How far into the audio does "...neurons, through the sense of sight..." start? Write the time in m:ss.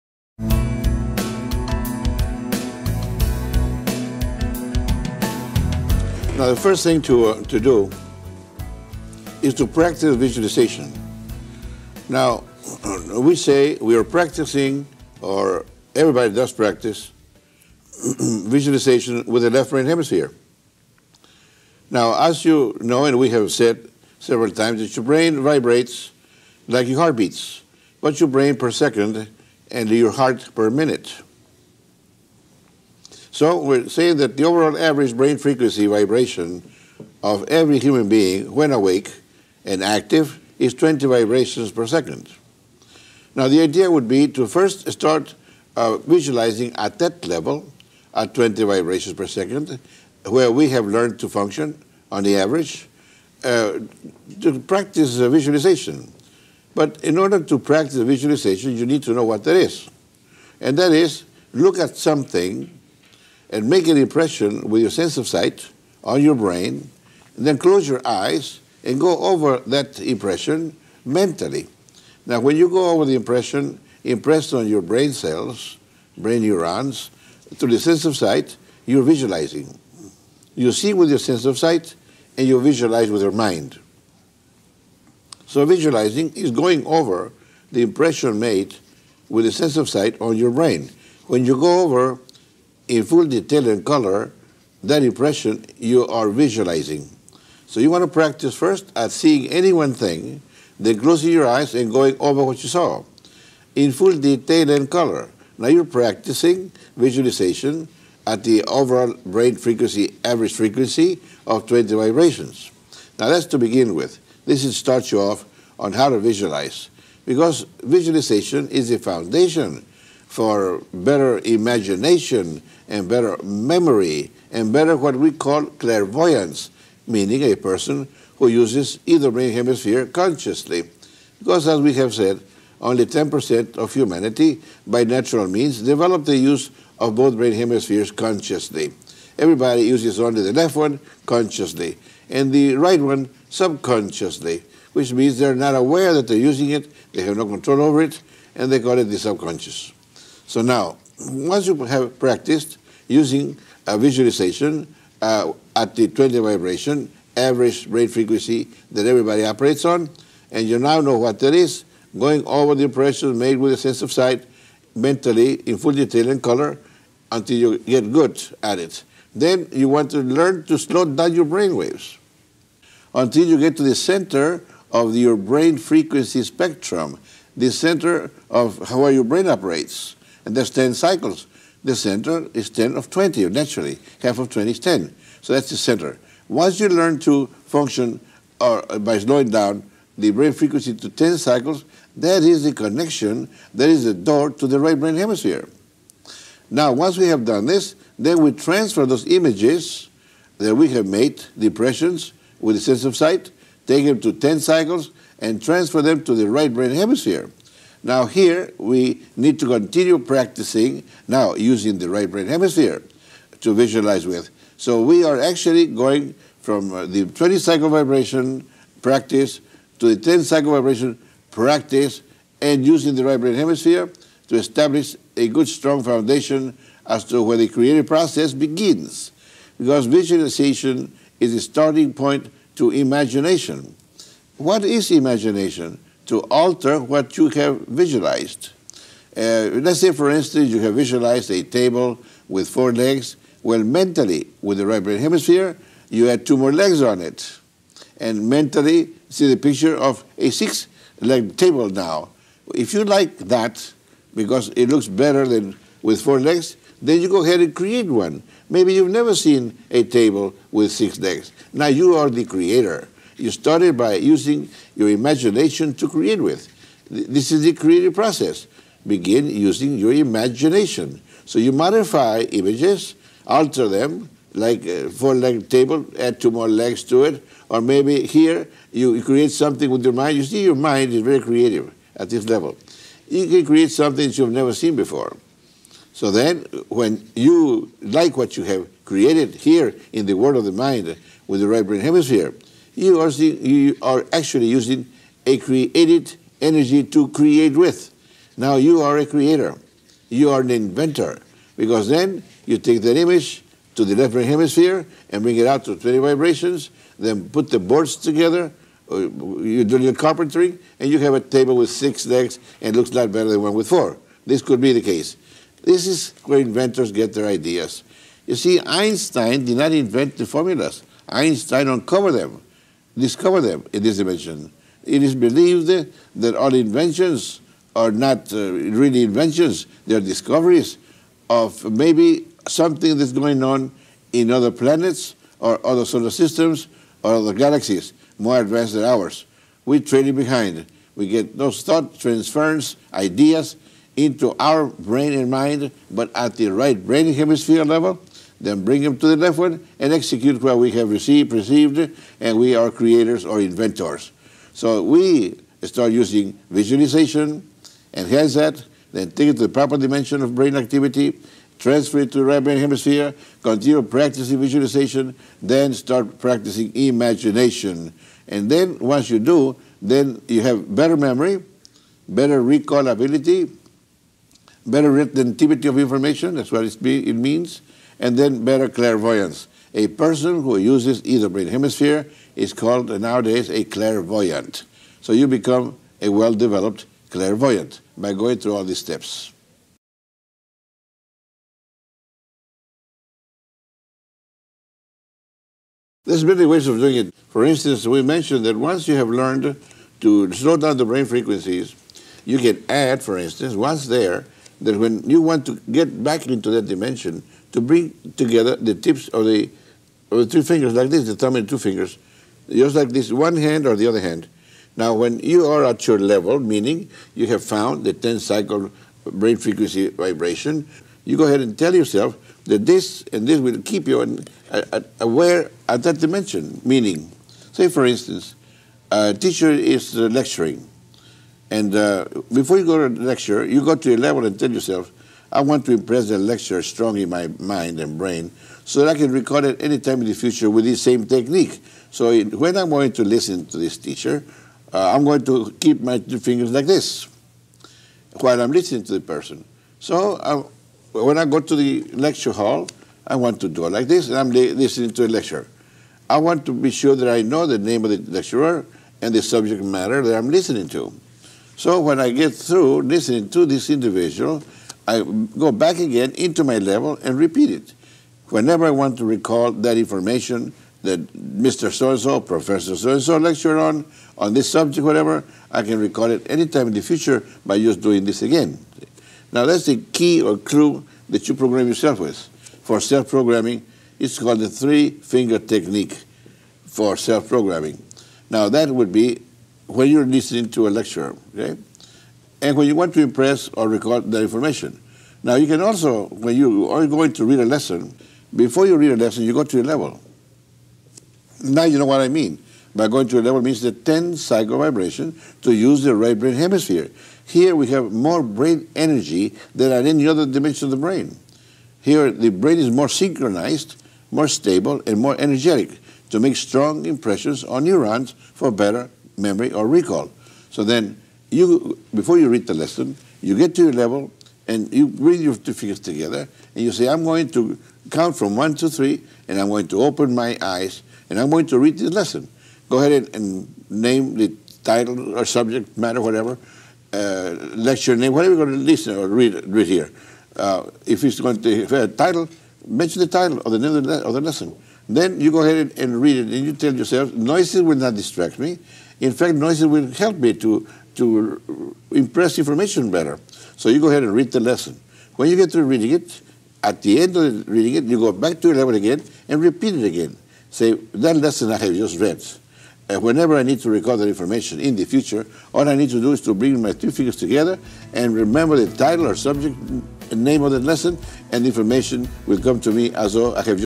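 1:16.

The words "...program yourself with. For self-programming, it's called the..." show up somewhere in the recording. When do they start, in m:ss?
8:01.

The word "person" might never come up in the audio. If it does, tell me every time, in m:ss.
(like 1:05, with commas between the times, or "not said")
2:07, 6:20, 7:29.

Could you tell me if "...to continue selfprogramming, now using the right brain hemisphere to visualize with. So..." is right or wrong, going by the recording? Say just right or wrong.
wrong.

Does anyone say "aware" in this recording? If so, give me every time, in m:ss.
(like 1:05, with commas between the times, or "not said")
2:25, 7:05.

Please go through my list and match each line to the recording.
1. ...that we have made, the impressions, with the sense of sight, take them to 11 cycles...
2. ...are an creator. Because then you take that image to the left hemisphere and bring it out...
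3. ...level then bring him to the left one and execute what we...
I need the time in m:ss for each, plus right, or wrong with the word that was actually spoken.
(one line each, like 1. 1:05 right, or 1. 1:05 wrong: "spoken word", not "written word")
1. 3:20 wrong: "10", not "11"
2. 5:00 wrong: "inventor", not "creator"
3. 5:47 right.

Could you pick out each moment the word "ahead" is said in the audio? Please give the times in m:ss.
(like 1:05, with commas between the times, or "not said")
4:17, 7:01, 8:52, 9:05, 9:14.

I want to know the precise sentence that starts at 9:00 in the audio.
Uh, if it's going to have a title, mention the title or the name of the, of the lesson.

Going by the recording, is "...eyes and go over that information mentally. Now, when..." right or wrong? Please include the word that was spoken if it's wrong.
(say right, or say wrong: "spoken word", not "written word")
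wrong: "impression", not "information".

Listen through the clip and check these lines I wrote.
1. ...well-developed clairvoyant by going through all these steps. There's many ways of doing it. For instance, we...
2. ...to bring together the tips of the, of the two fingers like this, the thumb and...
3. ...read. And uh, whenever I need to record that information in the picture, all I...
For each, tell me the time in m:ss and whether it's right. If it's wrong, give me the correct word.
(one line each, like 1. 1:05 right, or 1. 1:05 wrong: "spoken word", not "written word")
1. 6:26 right
2. 6:47 right
3. 9:22 wrong: "future", not "picture".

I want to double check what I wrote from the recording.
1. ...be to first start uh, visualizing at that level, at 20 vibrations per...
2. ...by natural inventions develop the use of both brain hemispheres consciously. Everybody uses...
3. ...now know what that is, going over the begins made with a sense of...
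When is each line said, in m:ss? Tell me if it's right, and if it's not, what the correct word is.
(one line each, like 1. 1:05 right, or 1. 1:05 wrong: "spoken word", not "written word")
1. 0:44 right
2. 2:14 wrong: "means", not "inventions"
3. 2:40 wrong: "impressions", not "begins".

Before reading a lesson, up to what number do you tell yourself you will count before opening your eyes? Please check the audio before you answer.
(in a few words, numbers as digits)
3.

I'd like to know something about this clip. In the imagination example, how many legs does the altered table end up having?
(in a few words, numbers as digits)
6.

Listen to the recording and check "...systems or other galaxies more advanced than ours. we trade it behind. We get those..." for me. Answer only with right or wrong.
right.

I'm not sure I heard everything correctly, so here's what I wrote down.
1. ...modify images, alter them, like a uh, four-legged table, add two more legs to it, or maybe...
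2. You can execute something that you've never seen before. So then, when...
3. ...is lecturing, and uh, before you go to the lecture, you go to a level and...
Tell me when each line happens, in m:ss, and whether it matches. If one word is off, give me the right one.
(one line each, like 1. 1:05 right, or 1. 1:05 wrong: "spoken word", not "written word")
1. 4:31 right
2. 4:43 wrong: "create", not "execute"
3. 7:09 right.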